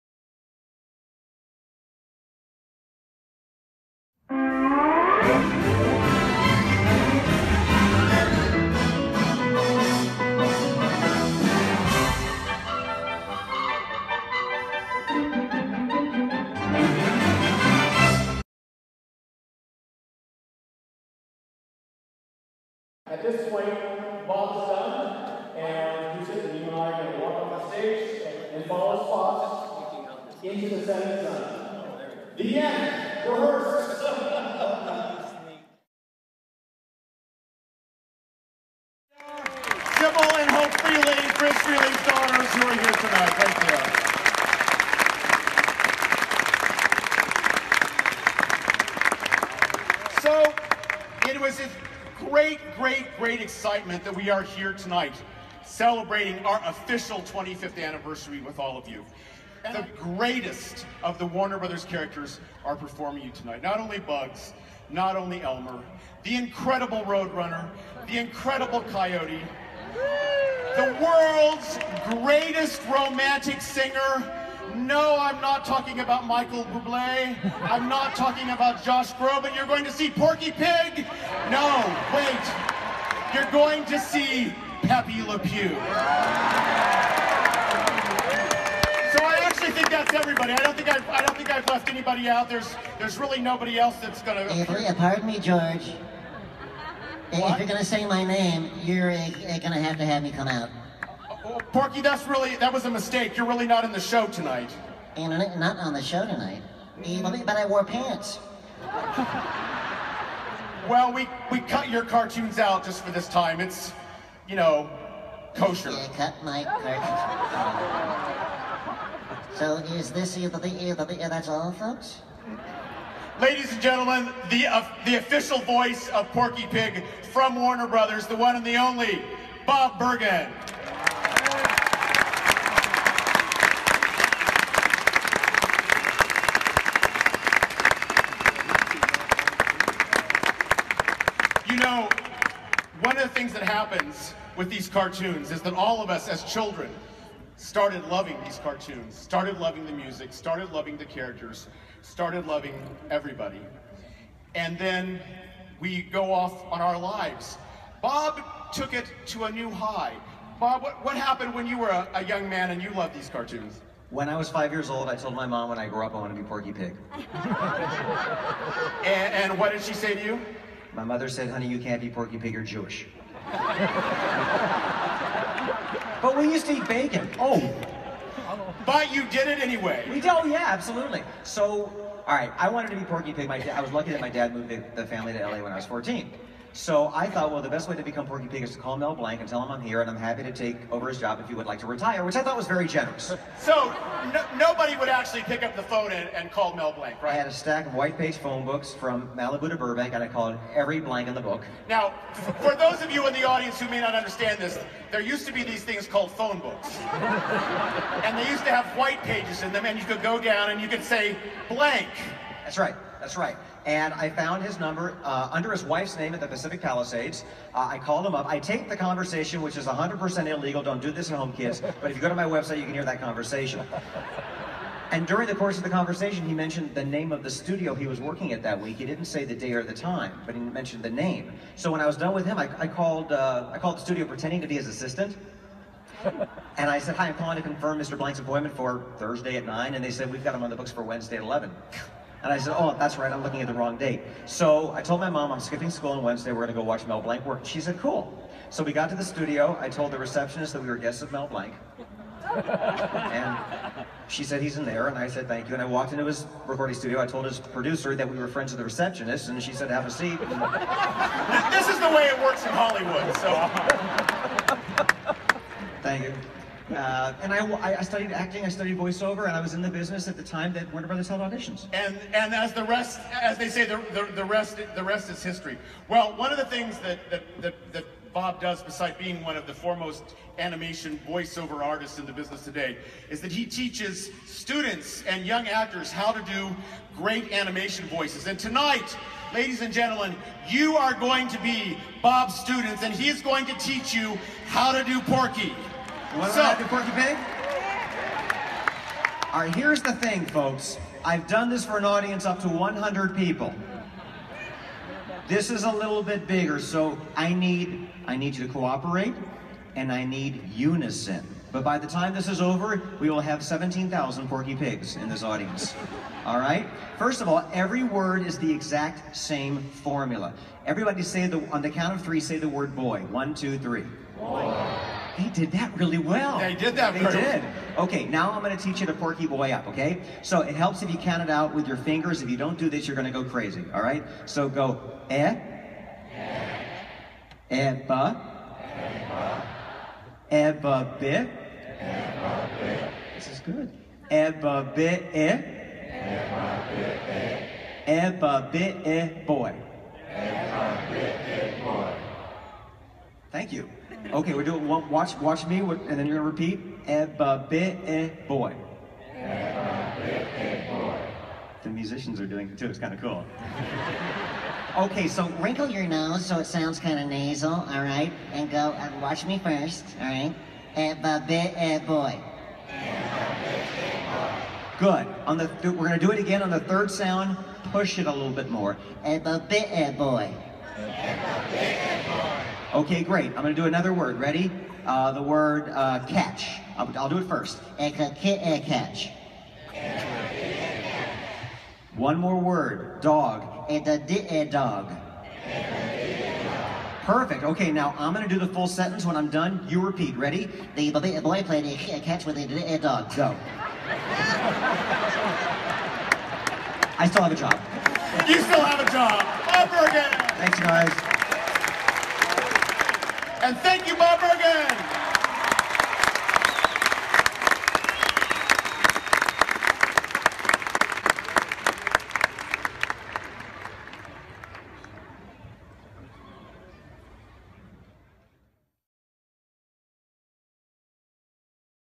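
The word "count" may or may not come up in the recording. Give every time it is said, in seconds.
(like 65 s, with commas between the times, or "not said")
321 s, 331 s.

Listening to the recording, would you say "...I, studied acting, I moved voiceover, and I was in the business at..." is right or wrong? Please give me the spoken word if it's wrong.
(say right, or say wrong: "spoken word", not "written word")
wrong: "studied", not "moved".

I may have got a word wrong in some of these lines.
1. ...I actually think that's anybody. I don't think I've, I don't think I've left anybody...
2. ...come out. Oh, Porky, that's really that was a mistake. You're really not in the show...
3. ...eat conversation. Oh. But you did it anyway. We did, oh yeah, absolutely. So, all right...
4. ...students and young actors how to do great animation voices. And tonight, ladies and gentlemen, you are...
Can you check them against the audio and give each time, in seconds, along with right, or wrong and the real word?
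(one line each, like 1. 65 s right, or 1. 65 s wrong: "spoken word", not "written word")
1. 89 s wrong: "everybody", not "anybody"
2. 100 s right
3. 176 s wrong: "bacon", not "conversation"
4. 284 s right.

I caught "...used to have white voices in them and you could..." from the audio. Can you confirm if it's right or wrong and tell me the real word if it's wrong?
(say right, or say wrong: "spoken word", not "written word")
wrong: "pages", not "voices".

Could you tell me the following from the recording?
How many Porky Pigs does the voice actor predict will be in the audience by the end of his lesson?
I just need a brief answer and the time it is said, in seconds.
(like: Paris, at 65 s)
17,000, at 313 s.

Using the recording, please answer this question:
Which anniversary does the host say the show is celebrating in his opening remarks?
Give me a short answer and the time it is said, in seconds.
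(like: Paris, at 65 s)
25th, at 57 s.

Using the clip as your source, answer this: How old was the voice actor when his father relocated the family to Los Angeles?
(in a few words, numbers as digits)
14.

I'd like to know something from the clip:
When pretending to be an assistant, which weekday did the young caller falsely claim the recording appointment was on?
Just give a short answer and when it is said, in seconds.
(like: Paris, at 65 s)
Thursday, at 239 s.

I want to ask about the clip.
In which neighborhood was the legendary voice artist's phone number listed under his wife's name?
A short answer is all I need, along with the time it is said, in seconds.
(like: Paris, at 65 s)
Pacific Palisades, at 216 s.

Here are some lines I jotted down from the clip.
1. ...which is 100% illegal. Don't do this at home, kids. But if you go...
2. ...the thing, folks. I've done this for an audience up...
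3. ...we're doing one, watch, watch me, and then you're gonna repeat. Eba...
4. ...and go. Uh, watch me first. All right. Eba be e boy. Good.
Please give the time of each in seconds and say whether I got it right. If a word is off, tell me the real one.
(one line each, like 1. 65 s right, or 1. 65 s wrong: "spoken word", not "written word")
1. 219 s right
2. 300 s right
3. 354 s right
4. 368 s right.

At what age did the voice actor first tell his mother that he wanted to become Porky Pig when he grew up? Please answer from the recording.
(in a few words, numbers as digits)
5.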